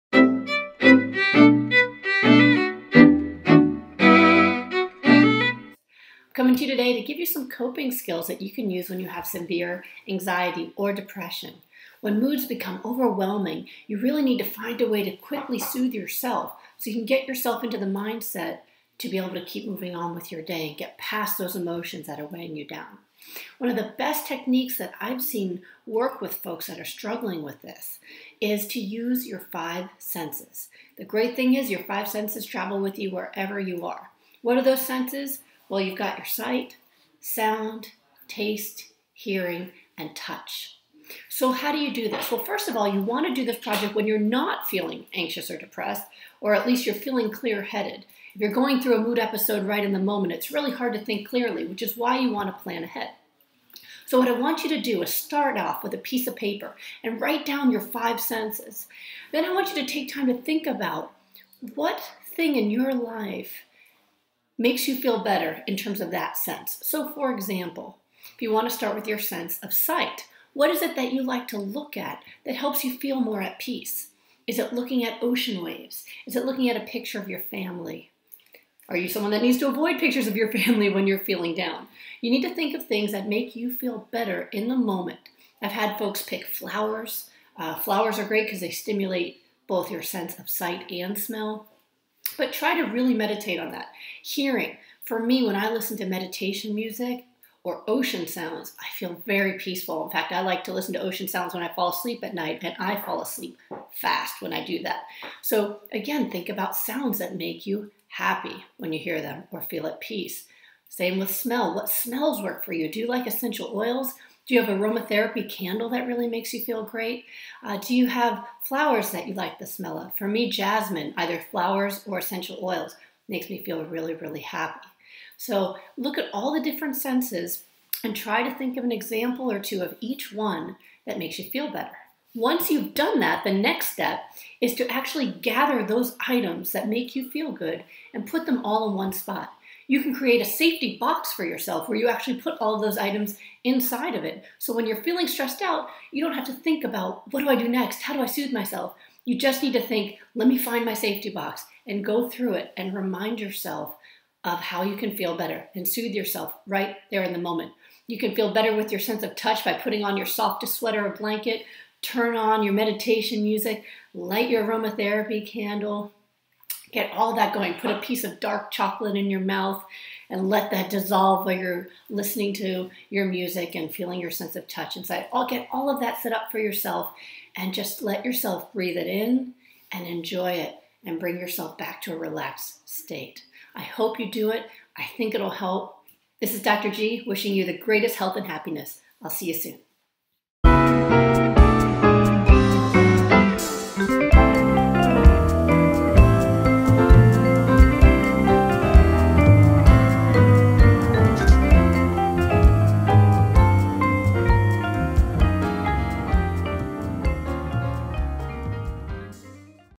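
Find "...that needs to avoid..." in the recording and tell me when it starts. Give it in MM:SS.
01:19.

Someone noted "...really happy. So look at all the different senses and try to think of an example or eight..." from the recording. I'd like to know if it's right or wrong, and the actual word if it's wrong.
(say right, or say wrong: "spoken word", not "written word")
wrong: "two", not "eight".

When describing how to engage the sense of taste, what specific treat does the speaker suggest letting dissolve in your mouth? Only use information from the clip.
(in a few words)
dark chocolate.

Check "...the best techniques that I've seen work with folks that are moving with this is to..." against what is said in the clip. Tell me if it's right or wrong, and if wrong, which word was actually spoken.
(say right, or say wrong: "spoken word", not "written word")
wrong: "struggling", not "moving".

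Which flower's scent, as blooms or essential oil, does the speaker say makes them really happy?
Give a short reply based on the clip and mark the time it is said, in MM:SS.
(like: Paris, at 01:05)
jasmine, at 02:00.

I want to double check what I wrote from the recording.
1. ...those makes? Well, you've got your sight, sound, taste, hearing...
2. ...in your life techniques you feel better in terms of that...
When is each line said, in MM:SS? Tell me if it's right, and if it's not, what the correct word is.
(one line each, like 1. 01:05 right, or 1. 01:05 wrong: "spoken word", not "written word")
1. 00:34 wrong: "senses", not "makes"
2. 01:02 wrong: "makes", not "techniques".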